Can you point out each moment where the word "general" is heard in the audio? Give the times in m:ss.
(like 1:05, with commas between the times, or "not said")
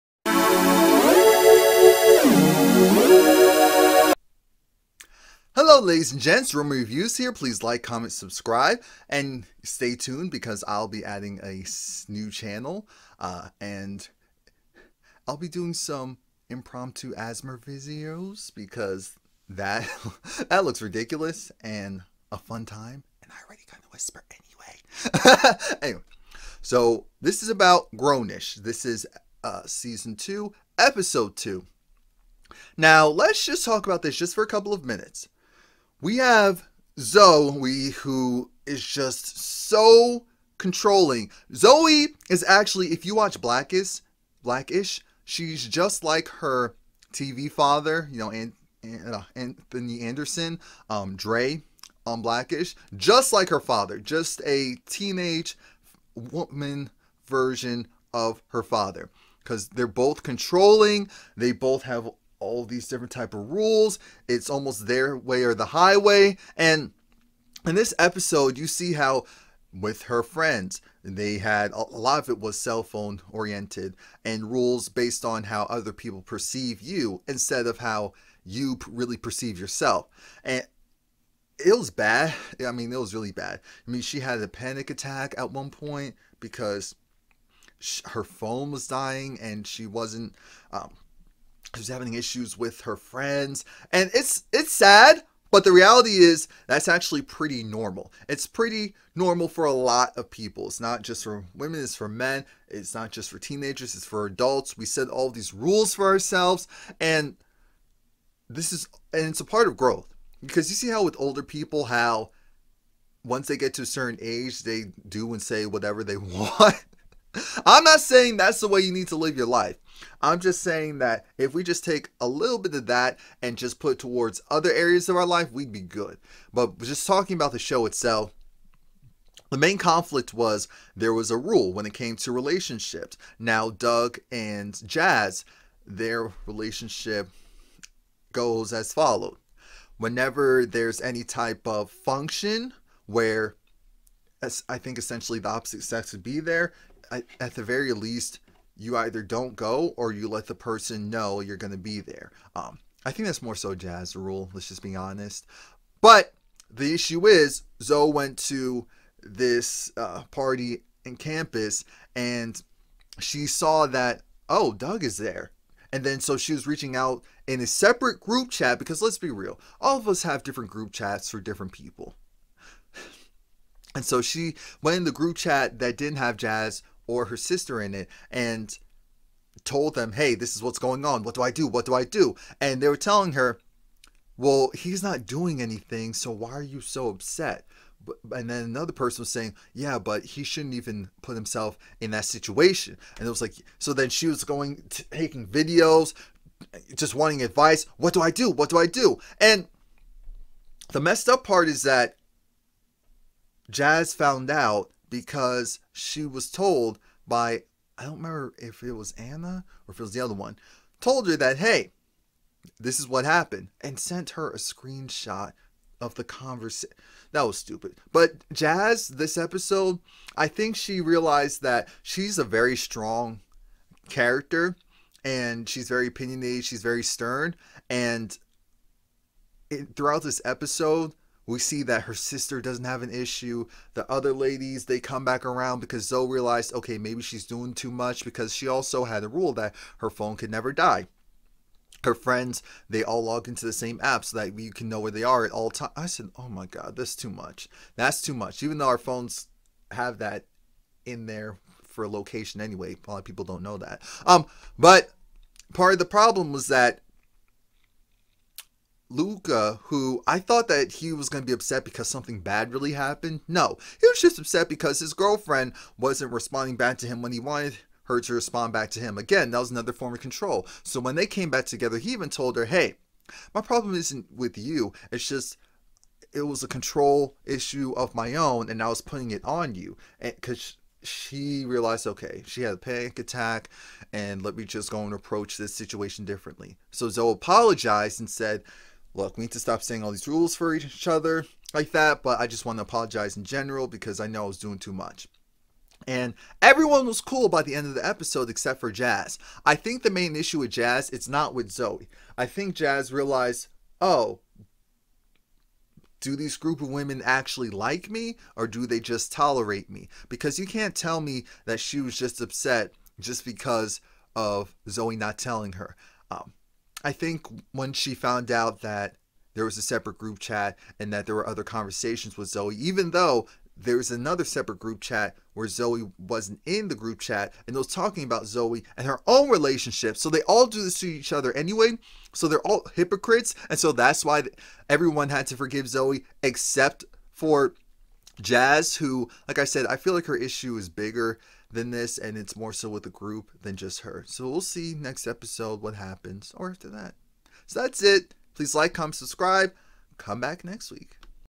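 4:53.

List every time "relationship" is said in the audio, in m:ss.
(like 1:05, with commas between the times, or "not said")
2:12, 2:16, 5:29.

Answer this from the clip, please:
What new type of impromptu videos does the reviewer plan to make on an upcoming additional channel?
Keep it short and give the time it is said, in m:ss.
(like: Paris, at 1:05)
ASMR, at 0:17.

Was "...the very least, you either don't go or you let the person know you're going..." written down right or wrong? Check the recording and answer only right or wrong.
right.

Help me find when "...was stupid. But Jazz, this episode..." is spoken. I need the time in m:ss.
3:37.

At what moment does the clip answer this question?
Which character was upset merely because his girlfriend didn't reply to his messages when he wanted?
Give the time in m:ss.
4:19.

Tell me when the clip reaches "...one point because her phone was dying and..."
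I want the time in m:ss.
1:25.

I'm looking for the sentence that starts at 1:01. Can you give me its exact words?
They both have all these different type of rules.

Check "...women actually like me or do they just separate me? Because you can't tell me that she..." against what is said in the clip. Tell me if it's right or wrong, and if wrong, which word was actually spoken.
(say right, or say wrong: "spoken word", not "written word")
wrong: "tolerate", not "separate".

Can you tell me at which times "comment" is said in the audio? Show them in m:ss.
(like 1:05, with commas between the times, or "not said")
0:07, 5:48.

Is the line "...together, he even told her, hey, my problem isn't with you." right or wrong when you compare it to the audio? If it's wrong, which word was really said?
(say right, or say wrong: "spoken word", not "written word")
right.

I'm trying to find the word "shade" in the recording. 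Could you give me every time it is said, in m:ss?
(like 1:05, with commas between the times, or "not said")
not said.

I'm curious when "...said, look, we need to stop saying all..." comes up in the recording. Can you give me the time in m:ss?
4:48.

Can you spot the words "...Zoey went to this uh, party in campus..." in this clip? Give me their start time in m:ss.
2:37.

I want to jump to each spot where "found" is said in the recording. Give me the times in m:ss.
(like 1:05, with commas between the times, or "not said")
3:24, 5:18.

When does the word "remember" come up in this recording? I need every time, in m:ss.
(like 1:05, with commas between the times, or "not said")
3:28.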